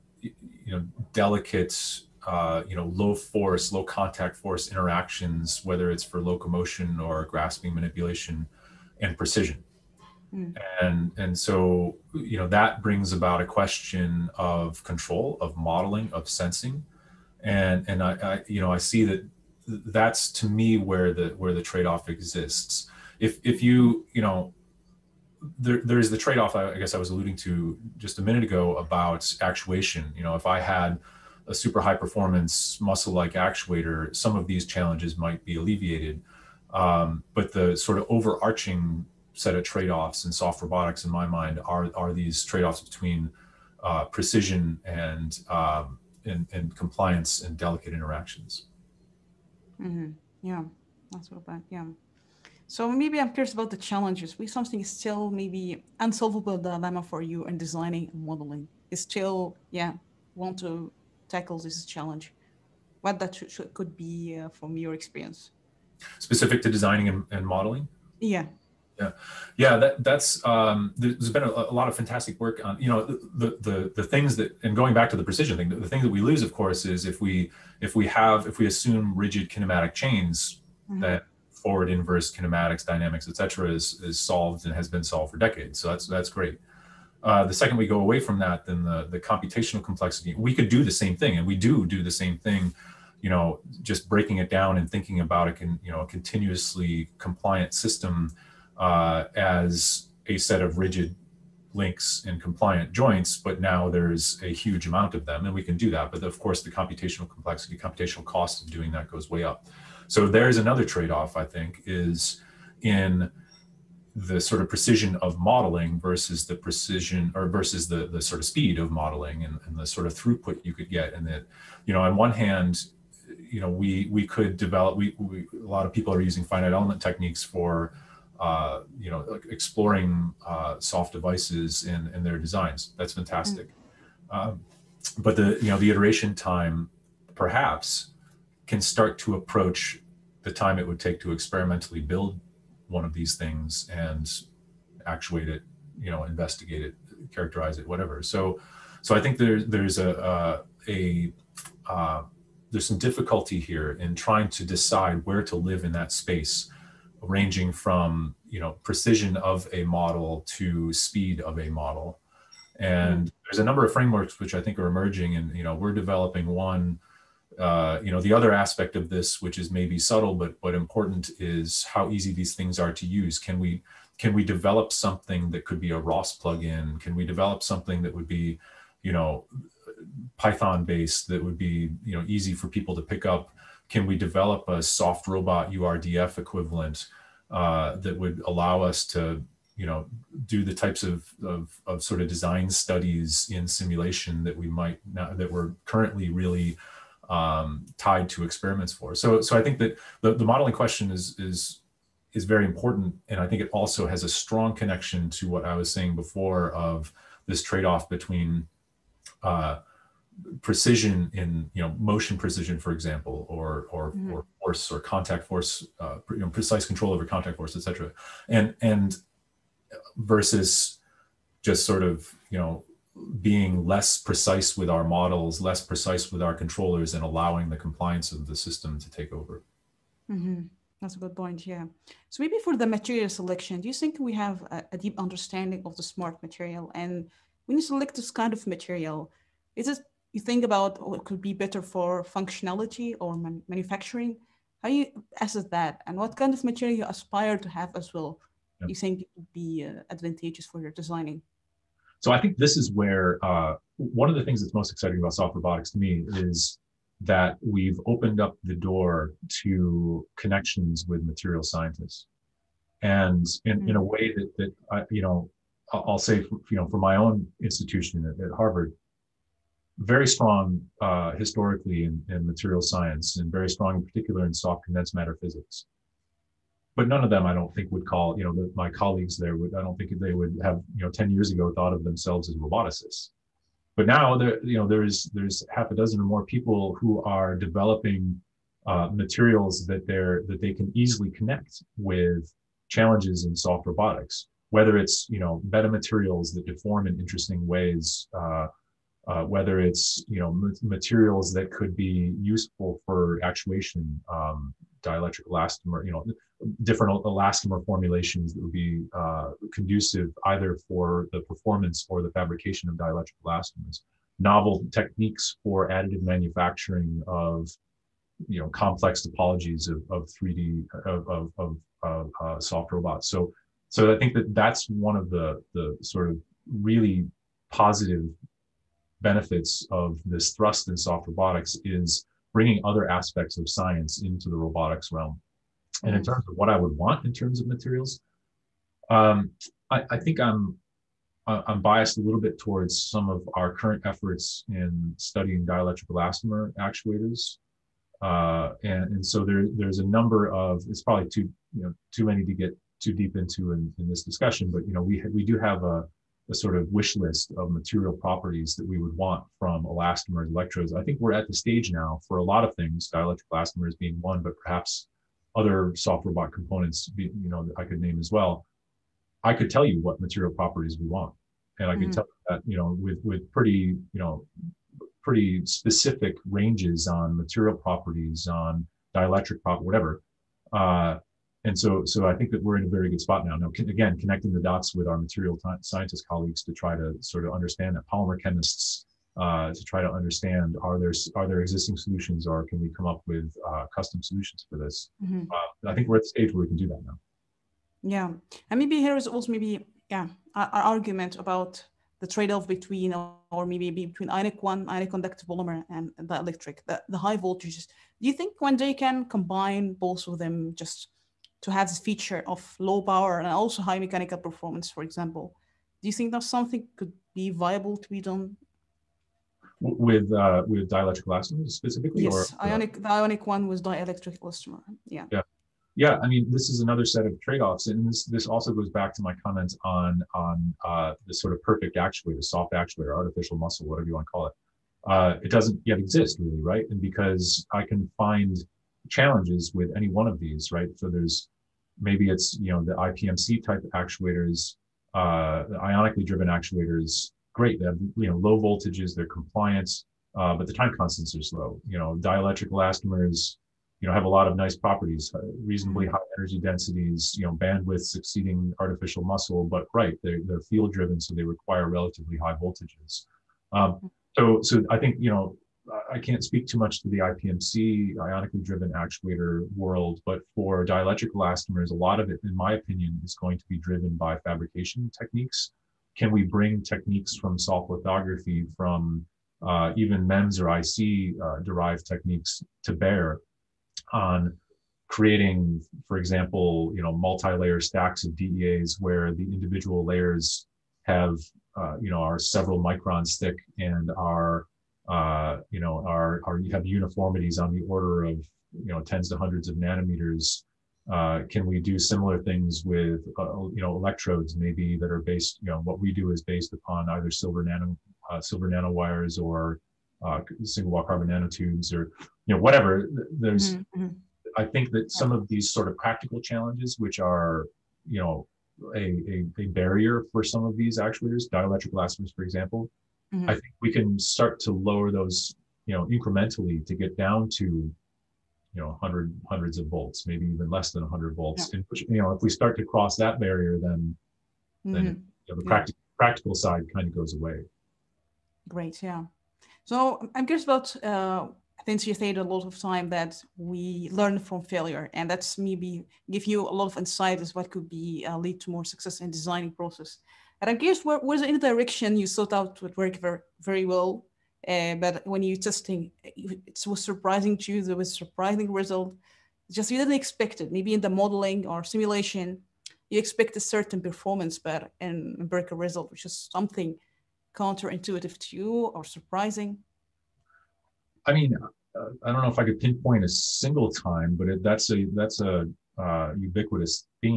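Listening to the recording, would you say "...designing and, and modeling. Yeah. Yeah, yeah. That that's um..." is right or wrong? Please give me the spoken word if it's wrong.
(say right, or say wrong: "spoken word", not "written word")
right.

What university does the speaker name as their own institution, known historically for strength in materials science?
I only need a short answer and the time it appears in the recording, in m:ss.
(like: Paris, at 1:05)
Harvard, at 4:28.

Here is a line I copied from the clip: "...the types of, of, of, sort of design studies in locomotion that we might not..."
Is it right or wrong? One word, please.
wrong.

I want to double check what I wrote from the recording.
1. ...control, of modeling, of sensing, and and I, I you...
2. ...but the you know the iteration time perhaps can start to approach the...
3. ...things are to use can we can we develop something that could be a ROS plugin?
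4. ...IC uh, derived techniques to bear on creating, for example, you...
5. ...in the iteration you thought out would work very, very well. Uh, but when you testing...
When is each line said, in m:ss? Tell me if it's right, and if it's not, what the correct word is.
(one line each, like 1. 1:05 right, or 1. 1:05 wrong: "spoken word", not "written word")
1. 0:14 right
2. 2:15 right
3. 2:52 right
4. 8:00 right
5. 9:11 wrong: "direction", not "iteration".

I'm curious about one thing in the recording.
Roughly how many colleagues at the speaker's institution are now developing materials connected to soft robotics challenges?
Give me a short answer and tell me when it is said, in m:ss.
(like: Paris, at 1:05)
half a dozen, at 4:45.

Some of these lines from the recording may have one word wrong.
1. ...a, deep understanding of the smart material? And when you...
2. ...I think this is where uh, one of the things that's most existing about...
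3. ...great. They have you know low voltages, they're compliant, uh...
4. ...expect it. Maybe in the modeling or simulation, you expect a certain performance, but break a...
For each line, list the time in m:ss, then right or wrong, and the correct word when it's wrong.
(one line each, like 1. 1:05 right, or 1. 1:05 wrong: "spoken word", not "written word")
1. 3:54 right
2. 4:12 wrong: "exciting", not "existing"
3. 7:27 right
4. 9:20 right.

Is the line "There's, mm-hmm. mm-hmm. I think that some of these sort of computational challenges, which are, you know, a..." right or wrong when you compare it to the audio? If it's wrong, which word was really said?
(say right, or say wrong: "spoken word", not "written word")
wrong: "practical", not "computational".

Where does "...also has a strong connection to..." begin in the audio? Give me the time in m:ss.
3:23.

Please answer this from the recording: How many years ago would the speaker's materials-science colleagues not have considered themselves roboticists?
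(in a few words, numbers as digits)
10.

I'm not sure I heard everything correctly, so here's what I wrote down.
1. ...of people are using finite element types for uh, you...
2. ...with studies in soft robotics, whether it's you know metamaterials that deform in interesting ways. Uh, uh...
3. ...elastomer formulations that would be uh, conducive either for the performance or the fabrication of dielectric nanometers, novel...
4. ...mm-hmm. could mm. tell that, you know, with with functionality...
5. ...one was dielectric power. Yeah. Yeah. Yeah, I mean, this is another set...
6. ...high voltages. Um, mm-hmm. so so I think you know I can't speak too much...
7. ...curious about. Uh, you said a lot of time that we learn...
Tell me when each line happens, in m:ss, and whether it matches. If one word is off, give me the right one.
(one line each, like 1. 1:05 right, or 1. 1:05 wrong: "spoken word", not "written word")
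1. 2:05 wrong: "techniques", not "types"
2. 4:51 wrong: "challenges", not "studies"
3. 5:07 wrong: "elastomers", not "nanometers"
4. 6:11 wrong: "pretty", not "functionality"
5. 7:03 wrong: "elastomer", not "power"
6. 7:42 right
7. 9:00 right.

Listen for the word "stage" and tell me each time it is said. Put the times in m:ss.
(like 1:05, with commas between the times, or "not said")
6:01, 6:36.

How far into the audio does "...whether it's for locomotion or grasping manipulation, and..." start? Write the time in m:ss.
0:05.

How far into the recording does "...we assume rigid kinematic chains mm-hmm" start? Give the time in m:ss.
1:18.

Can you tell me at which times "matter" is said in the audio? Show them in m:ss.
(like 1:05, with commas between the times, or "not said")
4:35.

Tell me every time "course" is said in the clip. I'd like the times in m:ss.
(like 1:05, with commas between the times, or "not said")
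1:16, 1:46.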